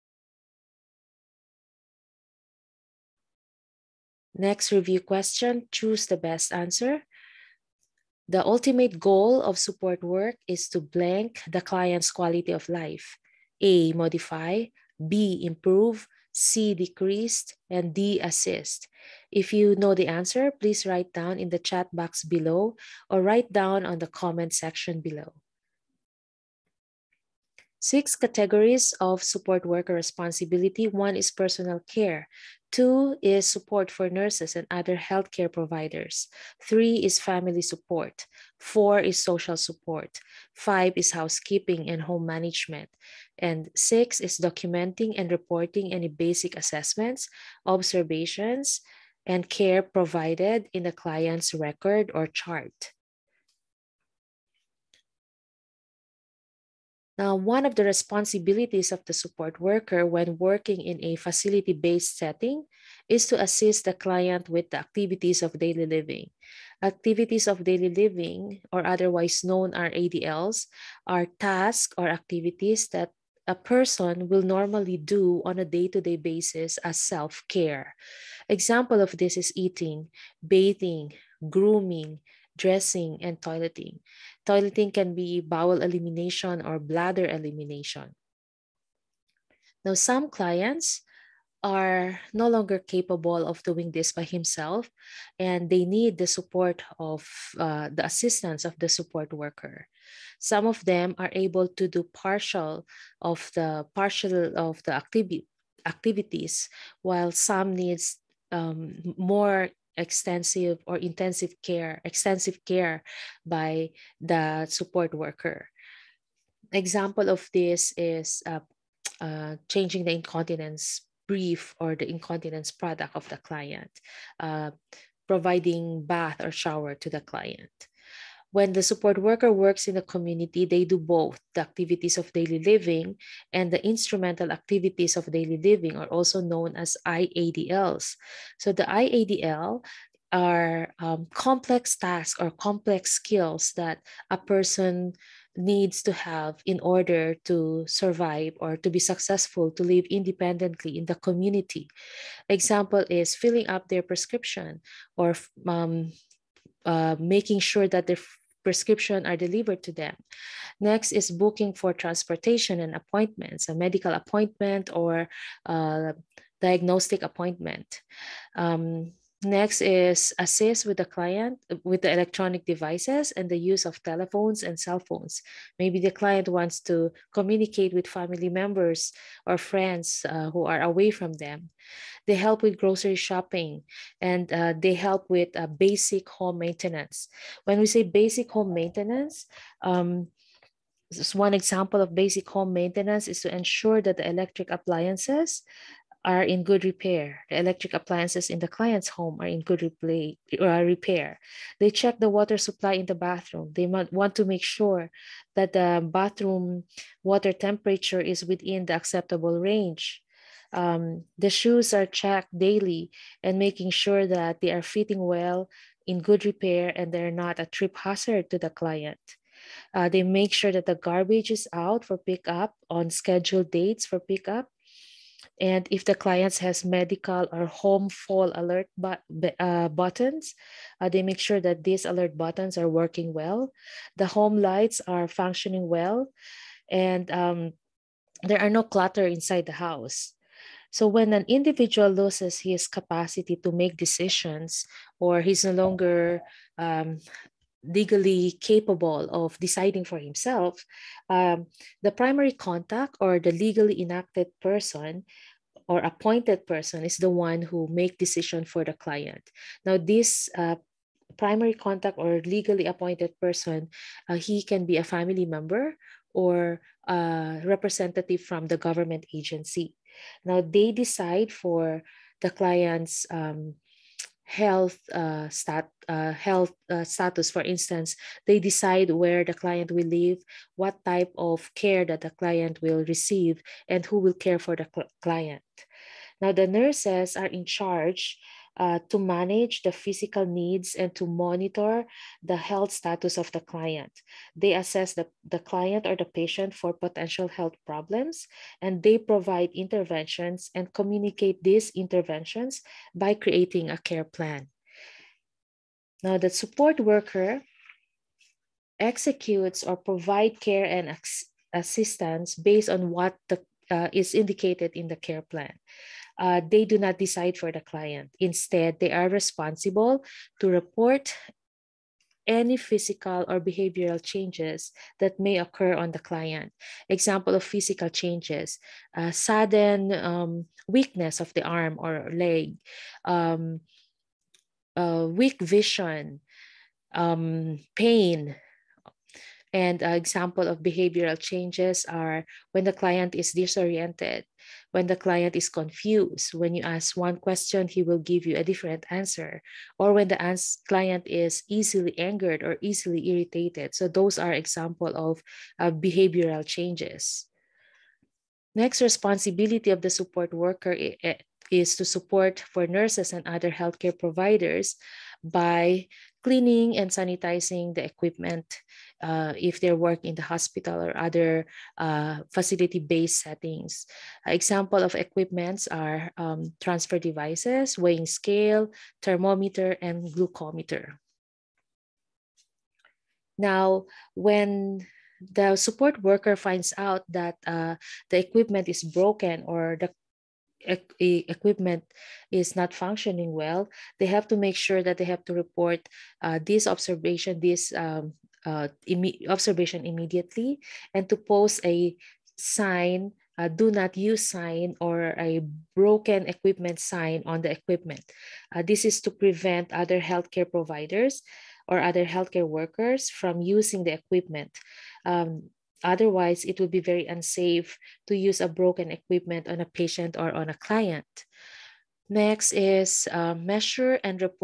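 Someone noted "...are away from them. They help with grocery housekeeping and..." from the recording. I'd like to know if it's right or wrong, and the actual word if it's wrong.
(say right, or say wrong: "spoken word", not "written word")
wrong: "shopping", not "housekeeping".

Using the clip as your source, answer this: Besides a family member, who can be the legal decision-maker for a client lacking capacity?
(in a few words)
representative from the government agency.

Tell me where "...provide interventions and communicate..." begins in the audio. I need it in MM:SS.
04:59.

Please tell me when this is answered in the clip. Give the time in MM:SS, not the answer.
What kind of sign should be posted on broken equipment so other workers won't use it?
06:43.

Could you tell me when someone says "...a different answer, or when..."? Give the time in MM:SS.
05:48.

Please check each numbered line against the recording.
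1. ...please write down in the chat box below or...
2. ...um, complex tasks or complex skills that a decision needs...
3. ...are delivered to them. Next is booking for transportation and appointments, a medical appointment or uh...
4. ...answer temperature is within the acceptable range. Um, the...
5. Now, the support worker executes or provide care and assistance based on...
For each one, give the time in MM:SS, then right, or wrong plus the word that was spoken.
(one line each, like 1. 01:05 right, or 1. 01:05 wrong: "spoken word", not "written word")
1. 00:20 right
2. 02:20 wrong: "person", not "decision"
3. 02:39 right
4. 03:27 wrong: "water", not "answer"
5. 05:06 right.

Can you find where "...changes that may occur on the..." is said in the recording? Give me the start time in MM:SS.
05:24.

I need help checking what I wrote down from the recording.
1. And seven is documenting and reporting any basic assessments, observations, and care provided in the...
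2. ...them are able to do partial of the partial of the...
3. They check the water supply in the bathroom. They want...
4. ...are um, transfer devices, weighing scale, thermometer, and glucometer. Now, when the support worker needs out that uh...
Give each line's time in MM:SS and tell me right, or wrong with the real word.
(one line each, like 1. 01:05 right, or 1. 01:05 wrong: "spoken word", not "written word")
1. 00:43 wrong: "six", not "seven"
2. 01:40 right
3. 03:21 right
4. 06:15 wrong: "finds", not "needs".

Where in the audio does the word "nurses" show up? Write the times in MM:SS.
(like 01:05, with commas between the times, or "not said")
00:34, 04:46, 06:02.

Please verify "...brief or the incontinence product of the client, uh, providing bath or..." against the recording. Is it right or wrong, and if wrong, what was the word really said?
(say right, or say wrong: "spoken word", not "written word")
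right.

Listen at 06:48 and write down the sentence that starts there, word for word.
Uh, this is to prevent other healthcare providers or other healthcare workers from using the equipment.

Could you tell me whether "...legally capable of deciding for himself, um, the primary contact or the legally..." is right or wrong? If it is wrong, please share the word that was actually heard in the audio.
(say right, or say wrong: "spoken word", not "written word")
right.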